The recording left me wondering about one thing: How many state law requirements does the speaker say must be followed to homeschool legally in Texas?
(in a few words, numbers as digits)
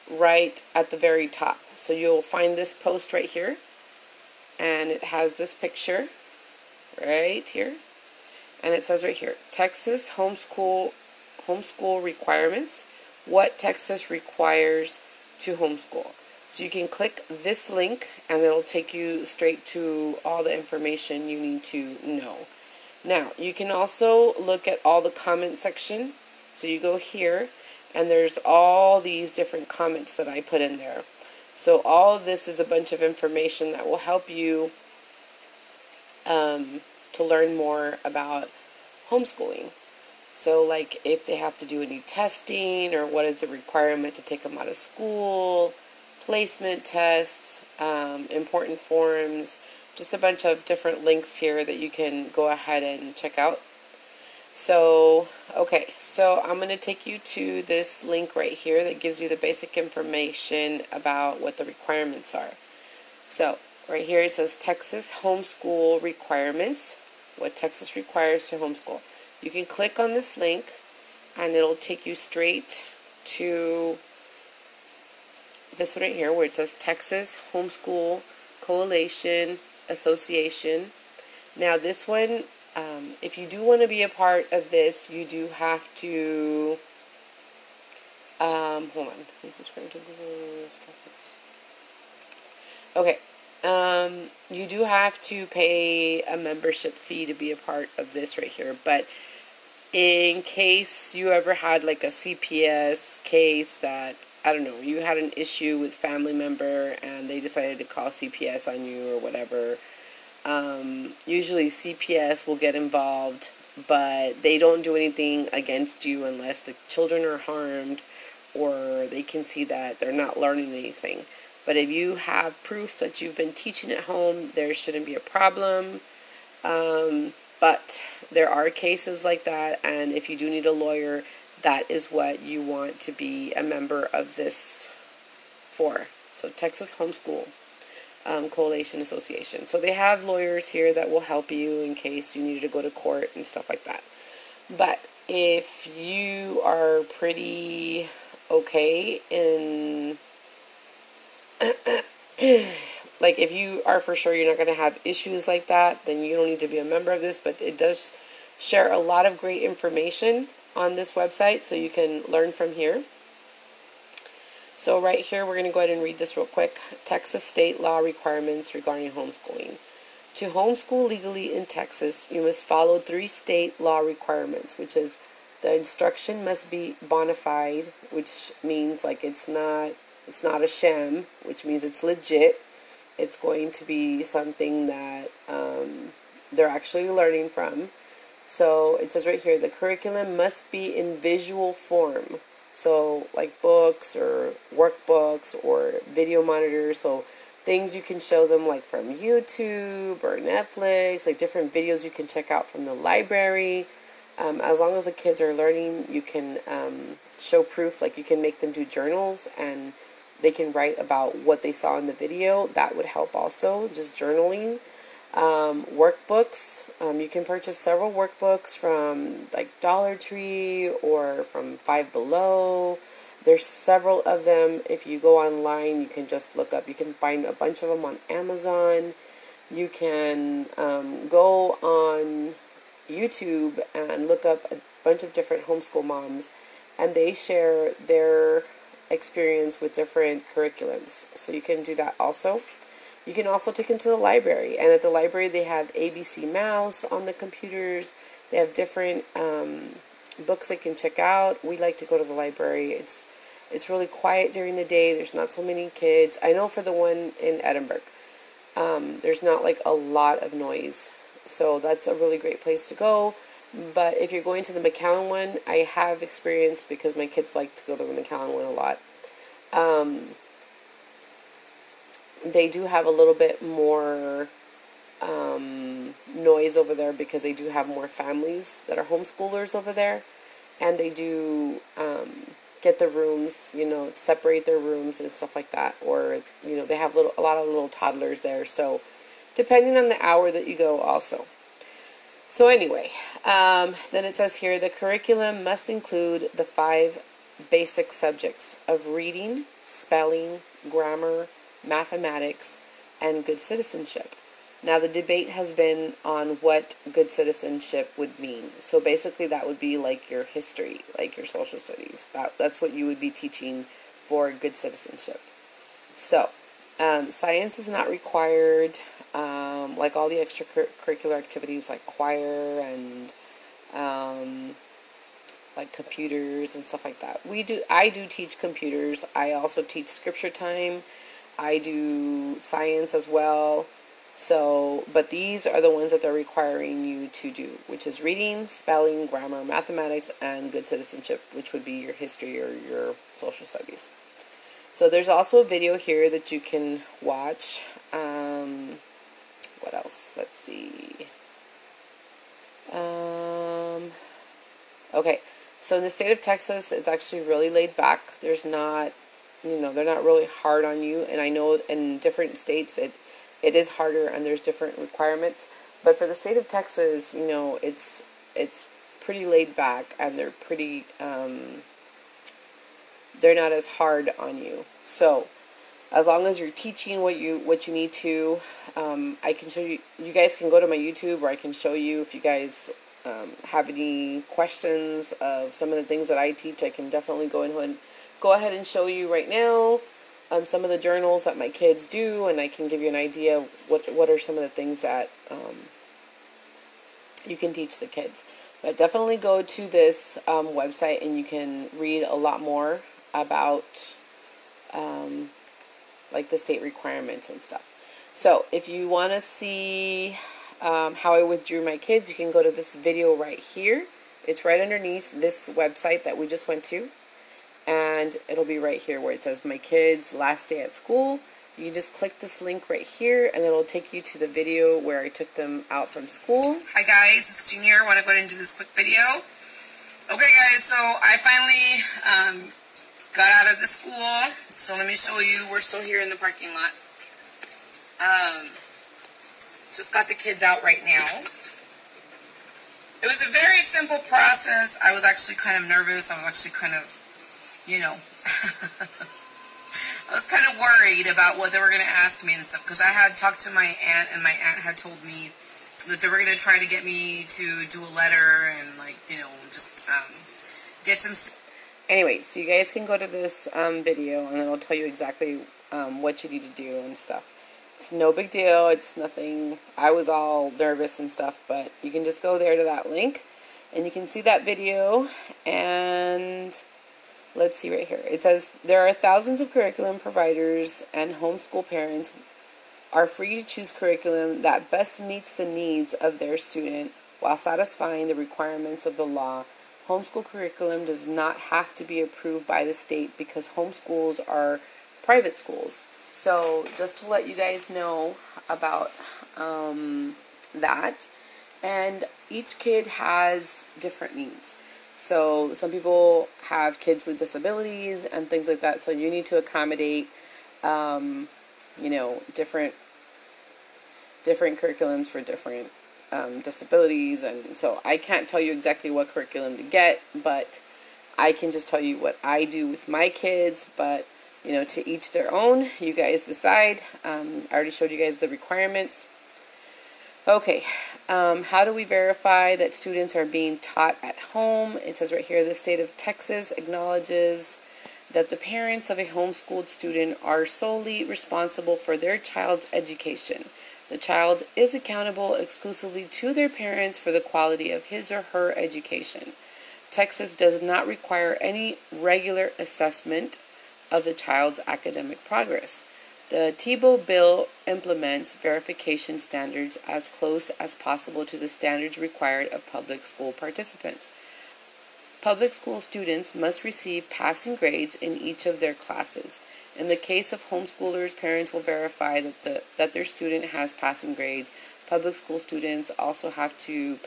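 3.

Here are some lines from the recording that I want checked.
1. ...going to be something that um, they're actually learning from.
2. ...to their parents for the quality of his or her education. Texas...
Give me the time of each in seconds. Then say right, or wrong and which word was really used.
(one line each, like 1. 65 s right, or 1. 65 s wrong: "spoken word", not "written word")
1. 183 s right
2. 546 s right.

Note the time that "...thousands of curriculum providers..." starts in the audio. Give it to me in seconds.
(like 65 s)
479 s.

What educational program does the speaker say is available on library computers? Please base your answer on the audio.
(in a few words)
ABC Mouse.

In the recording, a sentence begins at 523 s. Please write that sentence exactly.
But you know, to each their own.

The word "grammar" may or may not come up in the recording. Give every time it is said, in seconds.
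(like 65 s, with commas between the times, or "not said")
300 s, 339 s.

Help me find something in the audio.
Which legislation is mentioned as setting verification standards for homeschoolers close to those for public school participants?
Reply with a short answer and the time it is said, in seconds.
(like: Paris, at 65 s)
Tebow bill, at 556 s.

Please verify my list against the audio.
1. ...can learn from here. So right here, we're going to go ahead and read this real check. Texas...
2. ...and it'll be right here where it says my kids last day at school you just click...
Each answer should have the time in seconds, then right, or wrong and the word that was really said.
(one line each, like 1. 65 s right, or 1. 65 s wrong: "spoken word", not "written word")
1. 161 s wrong: "quick", not "check"
2. 417 s right.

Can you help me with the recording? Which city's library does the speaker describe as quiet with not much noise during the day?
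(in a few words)
Edinburg.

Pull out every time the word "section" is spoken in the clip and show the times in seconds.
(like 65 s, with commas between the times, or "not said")
25 s.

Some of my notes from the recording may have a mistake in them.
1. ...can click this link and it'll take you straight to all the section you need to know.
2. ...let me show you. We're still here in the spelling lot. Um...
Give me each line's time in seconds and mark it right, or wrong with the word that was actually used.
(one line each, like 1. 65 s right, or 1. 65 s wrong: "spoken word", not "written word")
1. 16 s wrong: "information", not "section"
2. 434 s wrong: "parking", not "spelling".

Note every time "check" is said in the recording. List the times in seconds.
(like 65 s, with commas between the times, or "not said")
53 s, 202 s, 250 s.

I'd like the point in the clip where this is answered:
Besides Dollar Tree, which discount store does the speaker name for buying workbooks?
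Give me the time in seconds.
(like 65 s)
221 s.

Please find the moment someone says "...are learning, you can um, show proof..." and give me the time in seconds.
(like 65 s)
205 s.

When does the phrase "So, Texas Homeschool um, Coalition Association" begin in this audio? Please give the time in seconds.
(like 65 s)
136 s.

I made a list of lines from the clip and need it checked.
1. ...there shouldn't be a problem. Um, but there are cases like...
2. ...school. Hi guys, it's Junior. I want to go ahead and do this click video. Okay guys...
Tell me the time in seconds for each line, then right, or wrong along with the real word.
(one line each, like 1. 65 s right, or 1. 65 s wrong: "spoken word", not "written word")
1. 124 s right
2. 426 s wrong: "quick", not "click".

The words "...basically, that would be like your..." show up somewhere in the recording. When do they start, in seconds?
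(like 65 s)
308 s.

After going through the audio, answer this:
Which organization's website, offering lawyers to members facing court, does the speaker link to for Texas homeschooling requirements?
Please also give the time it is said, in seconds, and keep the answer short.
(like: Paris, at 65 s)
Texas Homeschool Coalition Association, at 76 s.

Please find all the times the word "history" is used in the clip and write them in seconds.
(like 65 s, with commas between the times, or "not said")
310 s, 342 s.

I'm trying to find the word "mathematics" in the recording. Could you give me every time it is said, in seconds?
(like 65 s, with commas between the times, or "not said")
301 s, 339 s.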